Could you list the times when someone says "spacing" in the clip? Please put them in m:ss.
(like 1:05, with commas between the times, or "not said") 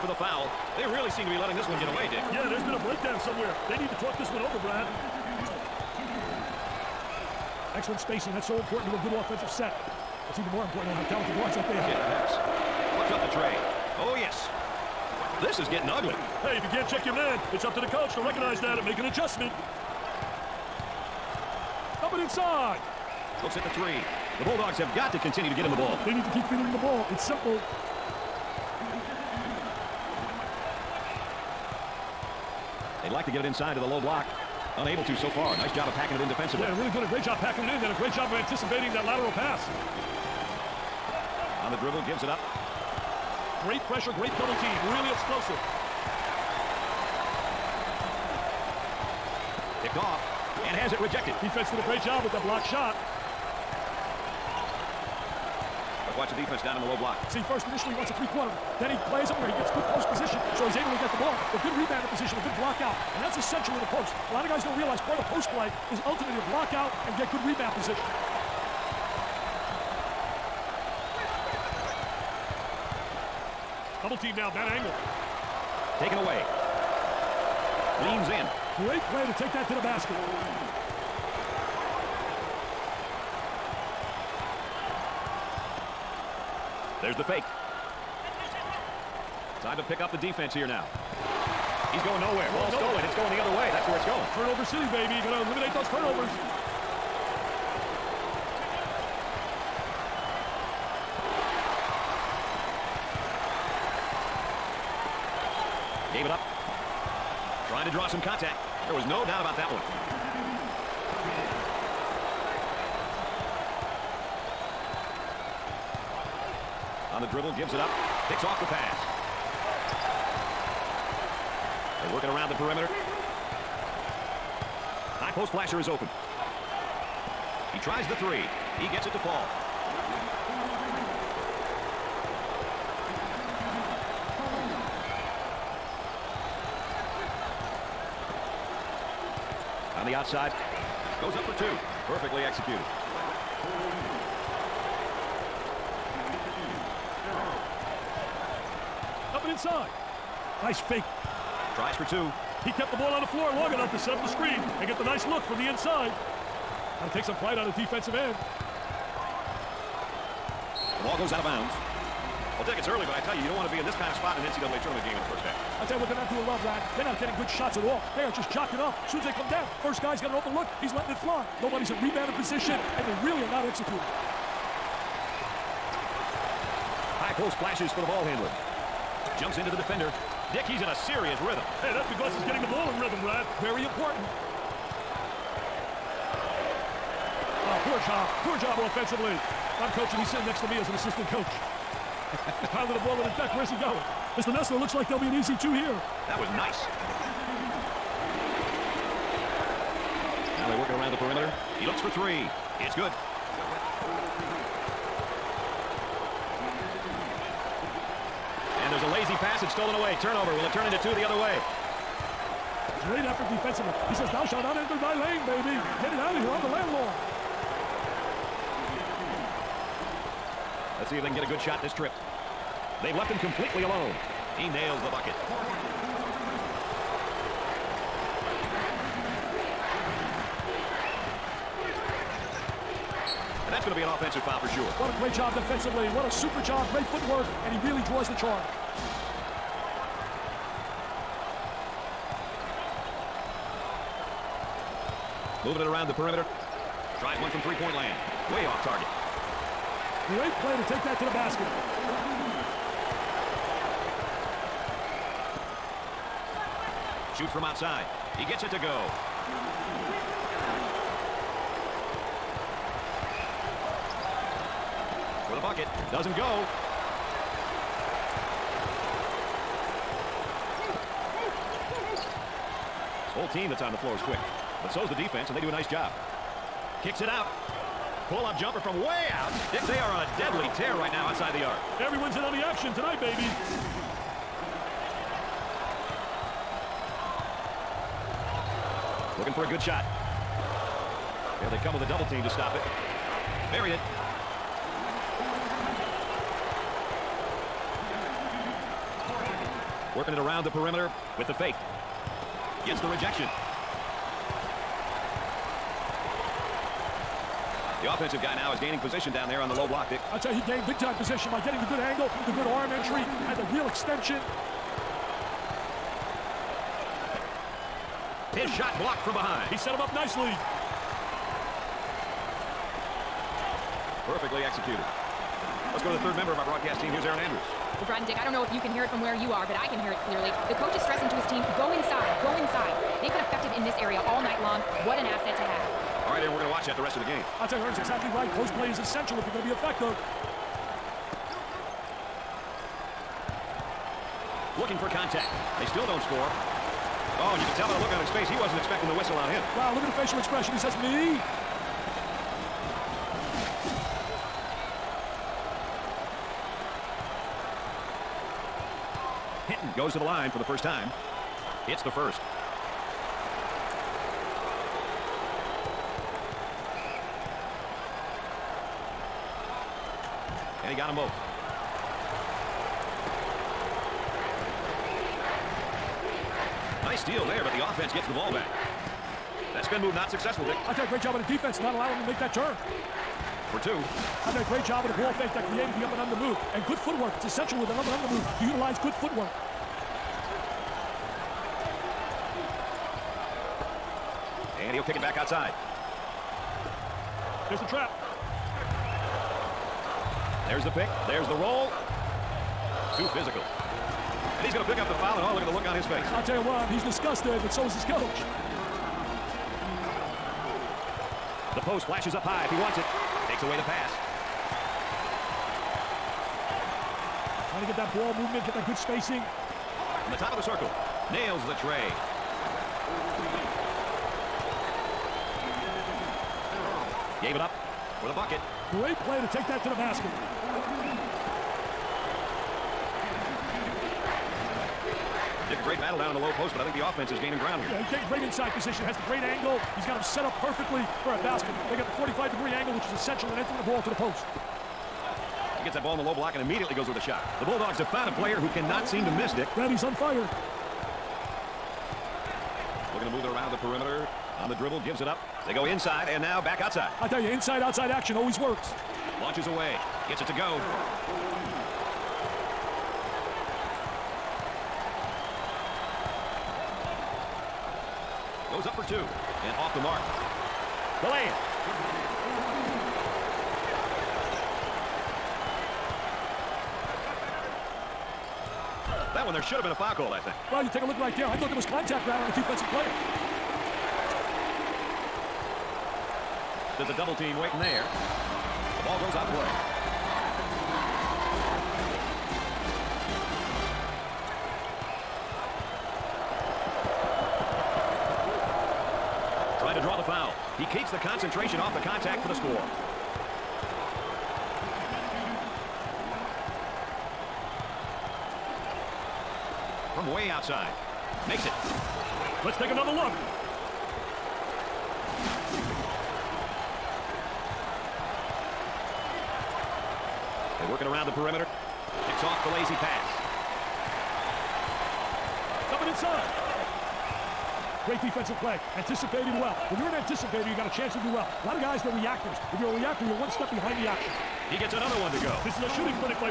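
0:07, 6:58.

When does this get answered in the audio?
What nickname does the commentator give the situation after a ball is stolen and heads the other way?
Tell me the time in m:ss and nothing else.
1:34.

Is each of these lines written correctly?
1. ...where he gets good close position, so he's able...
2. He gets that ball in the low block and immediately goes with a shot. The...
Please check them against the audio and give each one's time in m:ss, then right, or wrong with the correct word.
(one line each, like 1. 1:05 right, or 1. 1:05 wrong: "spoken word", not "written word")
1. 0:59 right
2. 7:25 right.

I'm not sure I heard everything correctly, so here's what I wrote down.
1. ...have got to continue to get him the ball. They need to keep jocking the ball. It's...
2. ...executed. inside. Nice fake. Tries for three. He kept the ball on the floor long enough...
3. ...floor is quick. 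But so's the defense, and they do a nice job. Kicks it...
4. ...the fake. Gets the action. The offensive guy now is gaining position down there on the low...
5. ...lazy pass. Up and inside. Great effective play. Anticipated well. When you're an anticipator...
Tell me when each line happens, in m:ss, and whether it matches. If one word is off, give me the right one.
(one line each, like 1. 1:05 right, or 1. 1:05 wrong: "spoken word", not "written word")
1. 0:24 wrong: "feeding", not "jocking"
2. 2:22 wrong: "two", not "three"
3. 4:33 right
4. 5:01 wrong: "rejection", not "action"
5. 8:42 wrong: "defensive", not "effective".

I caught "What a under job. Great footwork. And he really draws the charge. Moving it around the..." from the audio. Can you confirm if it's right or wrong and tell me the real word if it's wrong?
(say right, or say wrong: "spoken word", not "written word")
wrong: "super", not "under".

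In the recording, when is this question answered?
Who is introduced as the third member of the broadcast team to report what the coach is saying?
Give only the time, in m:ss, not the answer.
5:27.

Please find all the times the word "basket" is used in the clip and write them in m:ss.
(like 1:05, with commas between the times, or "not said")
1:19, 4:11, 7:09, 7:21.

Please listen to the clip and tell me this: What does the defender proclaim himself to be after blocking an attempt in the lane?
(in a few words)
The landlord.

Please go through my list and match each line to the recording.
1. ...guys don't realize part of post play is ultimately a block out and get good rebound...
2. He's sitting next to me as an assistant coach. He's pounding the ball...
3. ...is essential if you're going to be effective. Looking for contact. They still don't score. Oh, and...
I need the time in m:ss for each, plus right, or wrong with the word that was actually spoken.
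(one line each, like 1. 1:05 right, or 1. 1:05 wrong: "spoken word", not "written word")
1. 1:04 right
2. 3:10 right
3. 5:38 right.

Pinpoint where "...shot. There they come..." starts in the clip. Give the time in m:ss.
4:49.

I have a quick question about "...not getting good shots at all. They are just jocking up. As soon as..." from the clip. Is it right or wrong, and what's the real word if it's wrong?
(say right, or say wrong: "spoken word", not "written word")
right.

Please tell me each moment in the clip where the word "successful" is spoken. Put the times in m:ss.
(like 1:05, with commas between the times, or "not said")
6:20.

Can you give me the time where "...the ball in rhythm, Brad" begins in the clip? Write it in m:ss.
3:02.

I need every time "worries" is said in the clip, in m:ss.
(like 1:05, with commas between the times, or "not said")
not said.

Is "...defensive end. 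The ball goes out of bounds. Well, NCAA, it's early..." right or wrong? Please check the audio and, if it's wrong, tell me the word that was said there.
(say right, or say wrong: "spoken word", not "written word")
wrong: "Dick", not "NCAA".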